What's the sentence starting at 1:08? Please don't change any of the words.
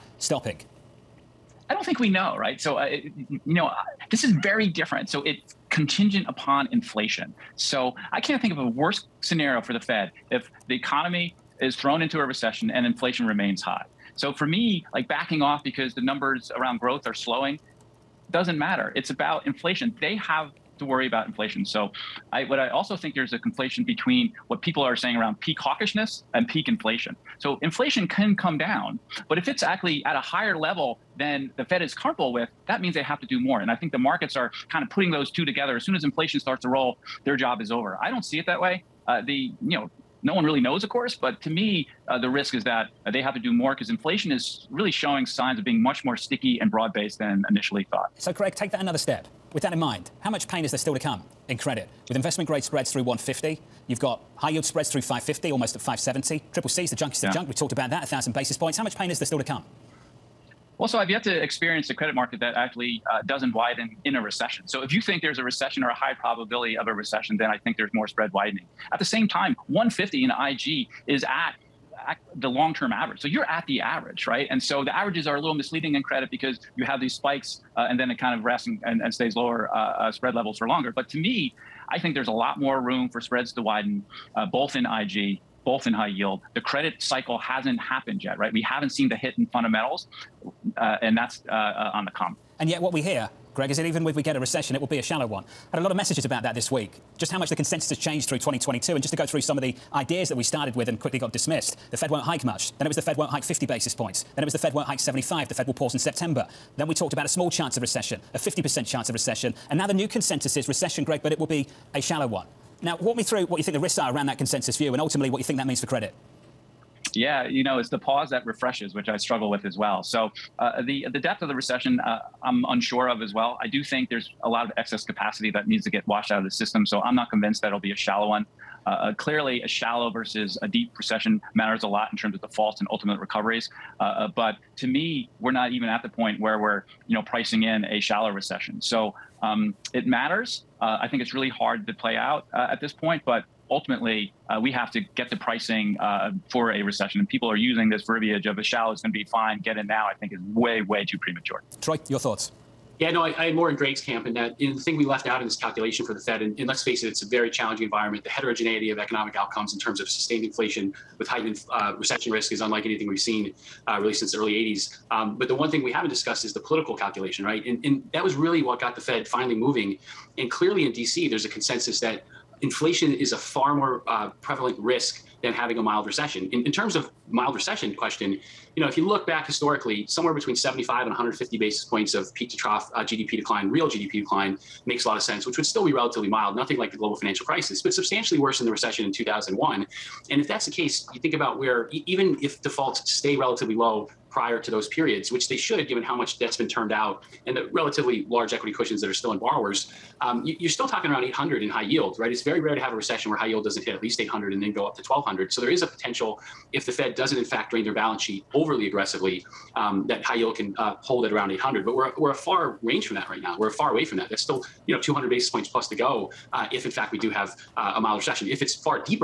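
At the same time, 150 in IG is at, at the long-term average.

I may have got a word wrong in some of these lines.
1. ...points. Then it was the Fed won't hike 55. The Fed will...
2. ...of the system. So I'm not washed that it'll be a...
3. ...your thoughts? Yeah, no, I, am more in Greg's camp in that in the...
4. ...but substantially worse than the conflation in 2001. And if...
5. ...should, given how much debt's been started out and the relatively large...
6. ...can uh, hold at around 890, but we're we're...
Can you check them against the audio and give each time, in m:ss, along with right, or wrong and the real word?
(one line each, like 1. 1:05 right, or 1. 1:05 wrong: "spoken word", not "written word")
1. 1:43 wrong: "75", not "55"
2. 2:06 wrong: "convinced", not "washed"
3. 2:32 right
4. 3:07 wrong: "recession", not "conflation"
5. 3:15 wrong: "turned", not "started"
6. 3:30 wrong: "800", not "890".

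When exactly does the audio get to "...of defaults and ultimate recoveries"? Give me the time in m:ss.
2:12.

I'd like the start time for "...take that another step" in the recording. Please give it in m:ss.
0:48.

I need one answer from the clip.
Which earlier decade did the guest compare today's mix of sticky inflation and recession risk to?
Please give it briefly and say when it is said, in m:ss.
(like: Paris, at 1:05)
early 80s, at 2:44.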